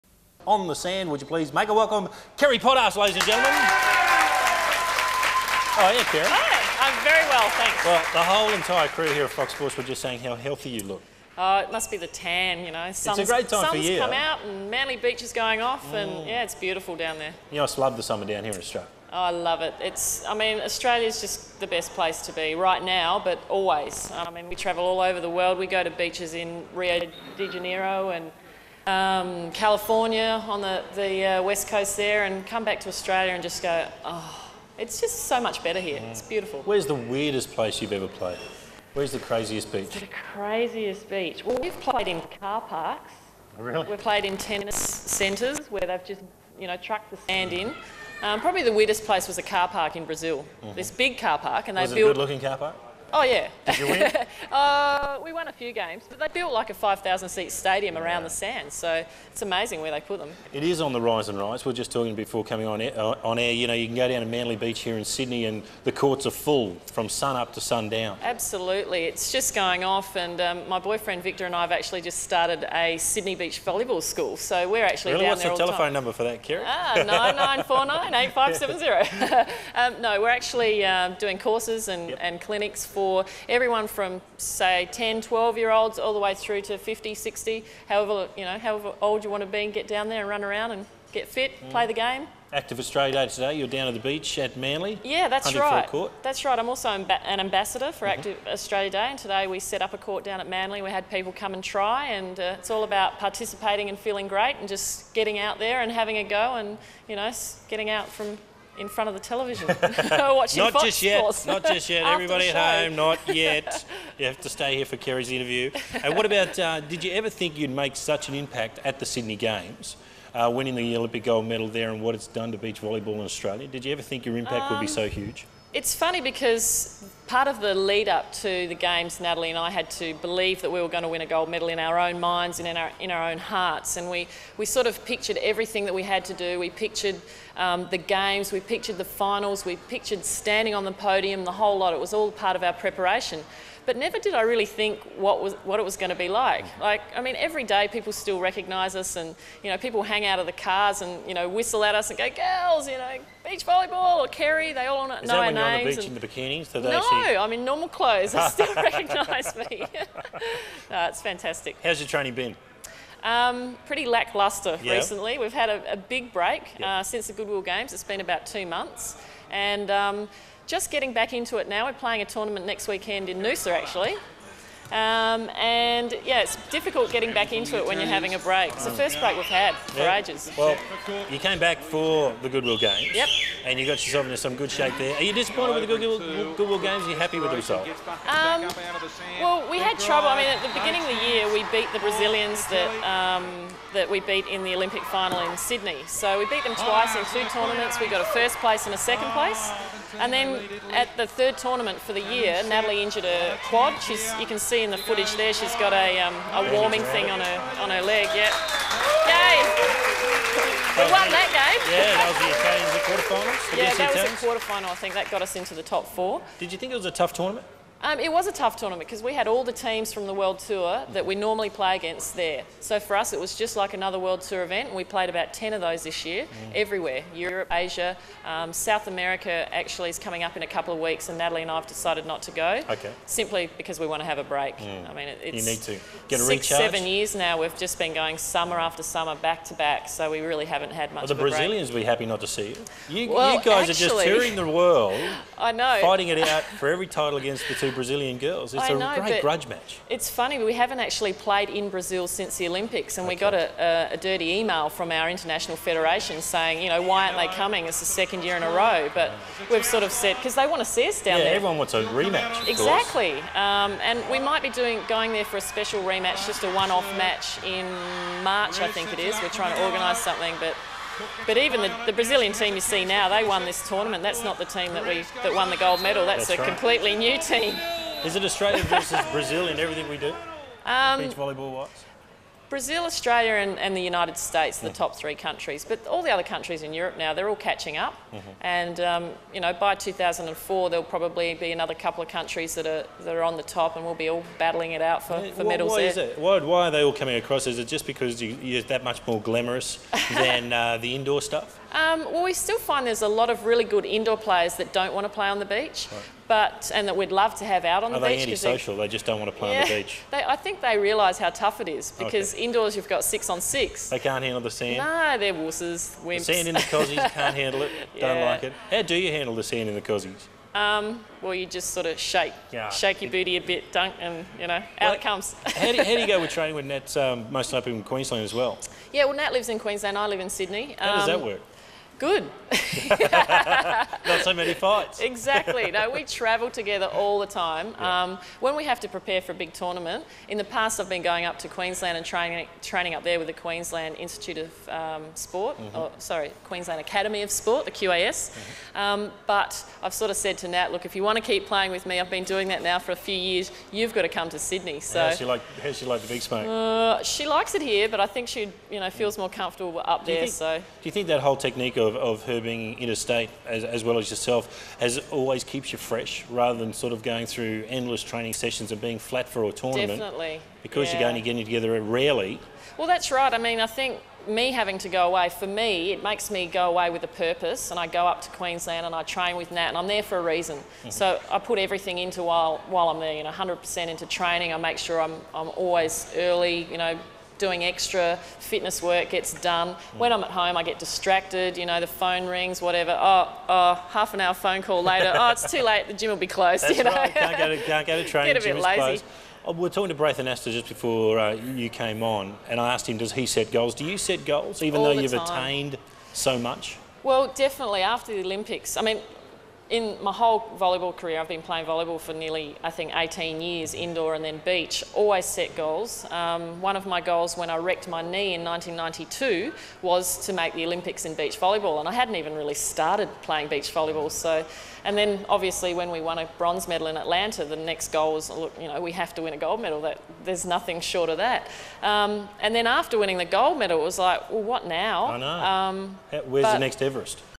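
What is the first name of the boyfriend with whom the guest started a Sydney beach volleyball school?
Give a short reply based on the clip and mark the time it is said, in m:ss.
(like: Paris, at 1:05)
Victor, at 1:11.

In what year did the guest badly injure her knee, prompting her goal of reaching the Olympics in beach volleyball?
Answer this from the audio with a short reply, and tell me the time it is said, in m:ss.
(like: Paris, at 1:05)
1992, at 6:58.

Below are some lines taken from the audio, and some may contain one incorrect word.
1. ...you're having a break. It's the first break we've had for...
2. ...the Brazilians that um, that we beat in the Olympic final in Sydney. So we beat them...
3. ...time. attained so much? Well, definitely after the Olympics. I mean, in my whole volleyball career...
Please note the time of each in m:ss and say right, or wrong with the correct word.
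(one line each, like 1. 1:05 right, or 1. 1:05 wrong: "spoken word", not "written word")
1. 2:57 right
2. 3:11 right
3. 6:45 right.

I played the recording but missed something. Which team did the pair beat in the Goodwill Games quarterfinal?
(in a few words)
The Italians.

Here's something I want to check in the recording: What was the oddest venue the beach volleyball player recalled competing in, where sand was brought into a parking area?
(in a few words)
A car park in Brazil.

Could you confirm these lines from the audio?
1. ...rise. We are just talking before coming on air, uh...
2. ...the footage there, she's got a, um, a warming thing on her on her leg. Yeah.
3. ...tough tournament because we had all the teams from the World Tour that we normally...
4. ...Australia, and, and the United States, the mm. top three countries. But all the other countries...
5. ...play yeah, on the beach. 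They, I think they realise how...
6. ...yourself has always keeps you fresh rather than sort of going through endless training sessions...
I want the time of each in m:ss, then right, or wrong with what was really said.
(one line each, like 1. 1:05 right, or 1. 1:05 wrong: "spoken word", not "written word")
1. 1:01 right
2. 3:24 right
3. 3:38 right
4. 4:43 right
5. 5:09 right
6. 6:04 right.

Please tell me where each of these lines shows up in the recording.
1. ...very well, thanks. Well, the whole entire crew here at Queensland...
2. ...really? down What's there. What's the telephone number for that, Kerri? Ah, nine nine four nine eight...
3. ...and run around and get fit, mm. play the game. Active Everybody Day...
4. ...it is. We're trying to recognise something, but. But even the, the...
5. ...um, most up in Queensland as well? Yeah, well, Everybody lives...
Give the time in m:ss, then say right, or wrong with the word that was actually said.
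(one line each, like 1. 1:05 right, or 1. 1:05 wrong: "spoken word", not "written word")
1. 0:07 wrong: "Fox", not "Queensland"
2. 1:15 right
3. 1:30 wrong: "Australia", not "Everybody"
4. 4:29 wrong: "organise", not "recognise"
5. 5:27 wrong: "Nat", not "Everybody".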